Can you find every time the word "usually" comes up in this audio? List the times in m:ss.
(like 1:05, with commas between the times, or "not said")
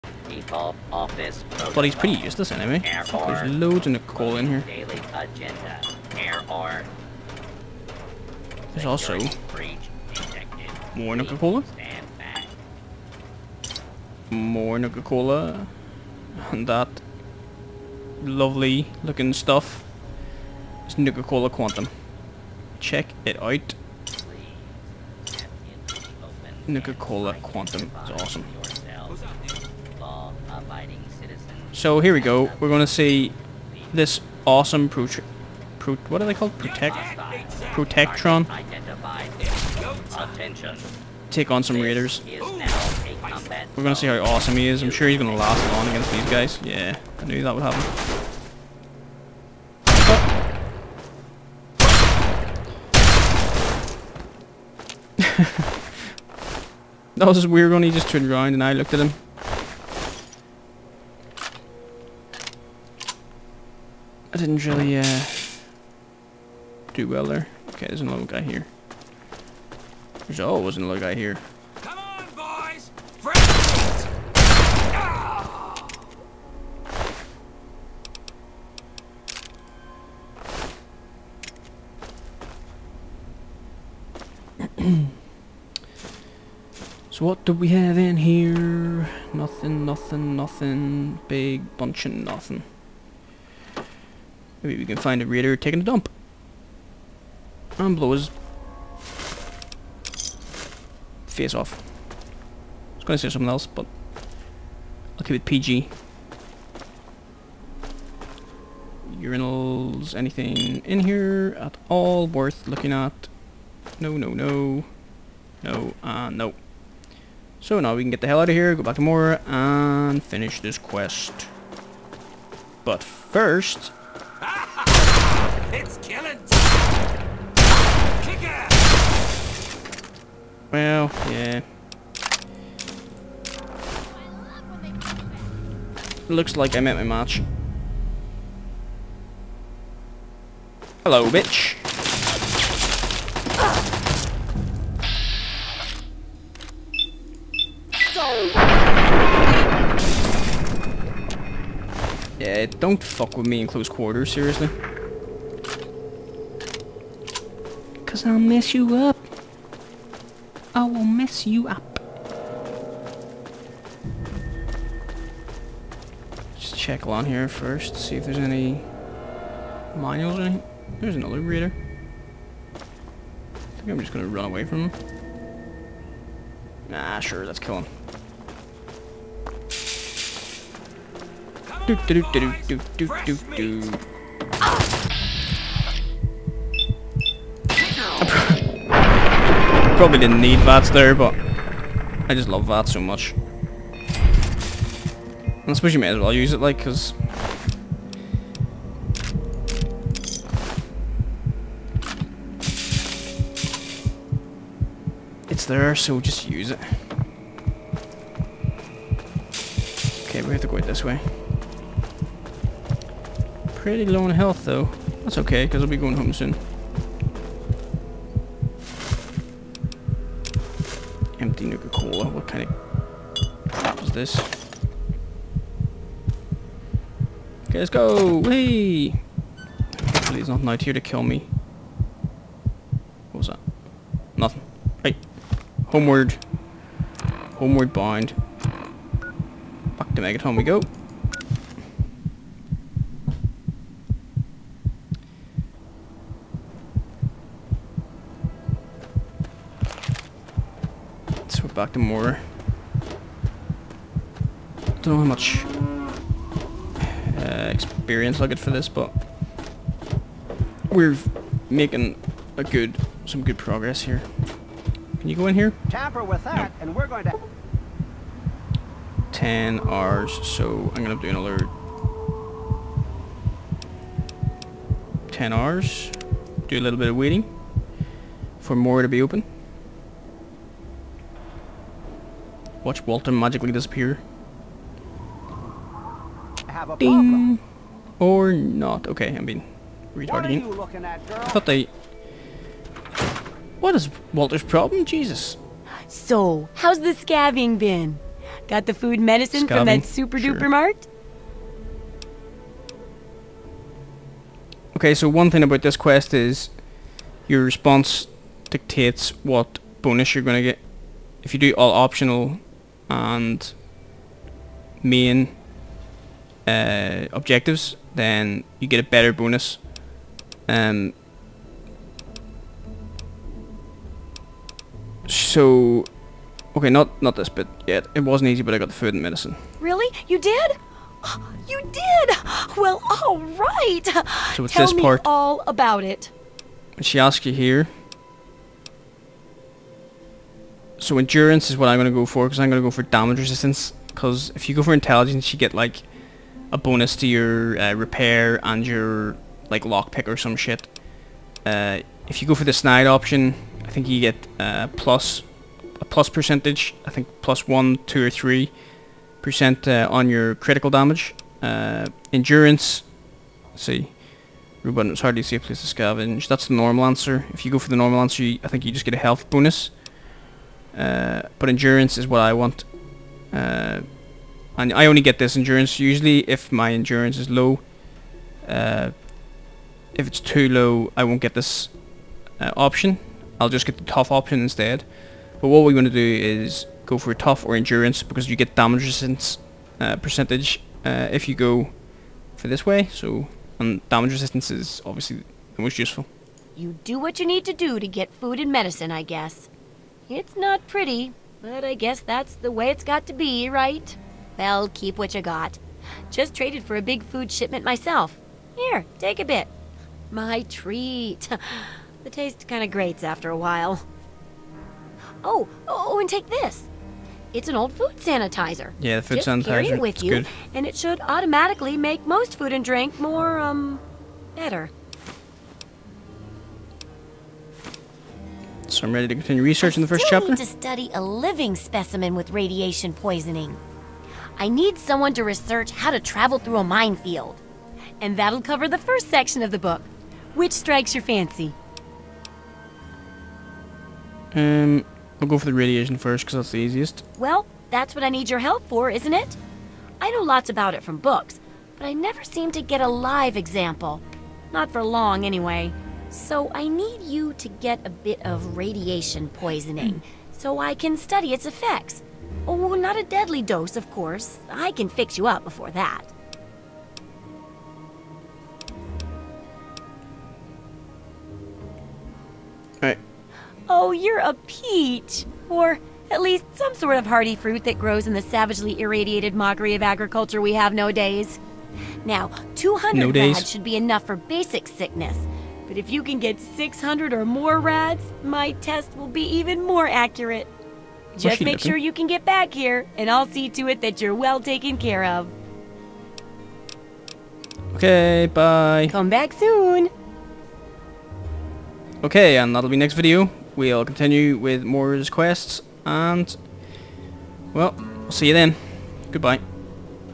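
6:15.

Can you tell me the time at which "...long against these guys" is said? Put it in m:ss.
0:45.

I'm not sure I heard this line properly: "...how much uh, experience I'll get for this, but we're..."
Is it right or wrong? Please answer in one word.
right.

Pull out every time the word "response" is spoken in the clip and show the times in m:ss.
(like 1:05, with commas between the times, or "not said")
5:07.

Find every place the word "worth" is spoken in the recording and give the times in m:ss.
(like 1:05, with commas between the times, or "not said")
1:52.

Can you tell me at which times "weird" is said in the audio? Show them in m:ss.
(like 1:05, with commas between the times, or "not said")
0:57.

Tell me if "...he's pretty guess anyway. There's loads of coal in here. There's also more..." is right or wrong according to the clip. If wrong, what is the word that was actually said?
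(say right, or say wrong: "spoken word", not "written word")
wrong: "useless", not "guess".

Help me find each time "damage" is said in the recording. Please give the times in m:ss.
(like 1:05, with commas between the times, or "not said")
5:43, 6:00, 6:28, 6:34.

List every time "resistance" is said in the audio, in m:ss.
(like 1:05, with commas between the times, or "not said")
5:43, 6:29, 6:34.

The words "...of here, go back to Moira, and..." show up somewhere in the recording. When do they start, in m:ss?
1:58.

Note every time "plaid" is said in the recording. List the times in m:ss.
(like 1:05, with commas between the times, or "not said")
not said.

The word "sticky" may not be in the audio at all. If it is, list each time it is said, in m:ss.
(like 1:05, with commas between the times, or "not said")
not said.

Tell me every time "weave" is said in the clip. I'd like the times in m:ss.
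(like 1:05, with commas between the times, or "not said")
not said.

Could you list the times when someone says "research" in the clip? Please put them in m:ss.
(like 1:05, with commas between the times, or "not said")
7:09, 7:15.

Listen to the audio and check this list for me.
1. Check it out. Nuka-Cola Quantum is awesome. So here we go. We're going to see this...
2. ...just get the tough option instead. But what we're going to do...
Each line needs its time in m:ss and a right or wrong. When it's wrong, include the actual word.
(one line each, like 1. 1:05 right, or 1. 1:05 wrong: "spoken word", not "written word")
1. 0:22 right
2. 6:23 right.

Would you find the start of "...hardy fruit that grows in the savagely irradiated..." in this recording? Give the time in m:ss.
7:57.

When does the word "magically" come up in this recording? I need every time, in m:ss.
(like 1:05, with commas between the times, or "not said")
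4:43.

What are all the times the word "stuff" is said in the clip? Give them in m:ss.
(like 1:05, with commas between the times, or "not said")
0:19.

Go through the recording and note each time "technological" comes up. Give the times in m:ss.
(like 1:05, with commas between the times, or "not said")
not said.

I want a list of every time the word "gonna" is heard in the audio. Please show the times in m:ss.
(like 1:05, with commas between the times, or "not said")
2:54, 4:31.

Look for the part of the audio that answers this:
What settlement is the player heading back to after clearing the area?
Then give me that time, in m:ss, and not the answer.
4:00.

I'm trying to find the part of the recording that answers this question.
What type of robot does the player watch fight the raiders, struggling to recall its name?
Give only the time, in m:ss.
0:37.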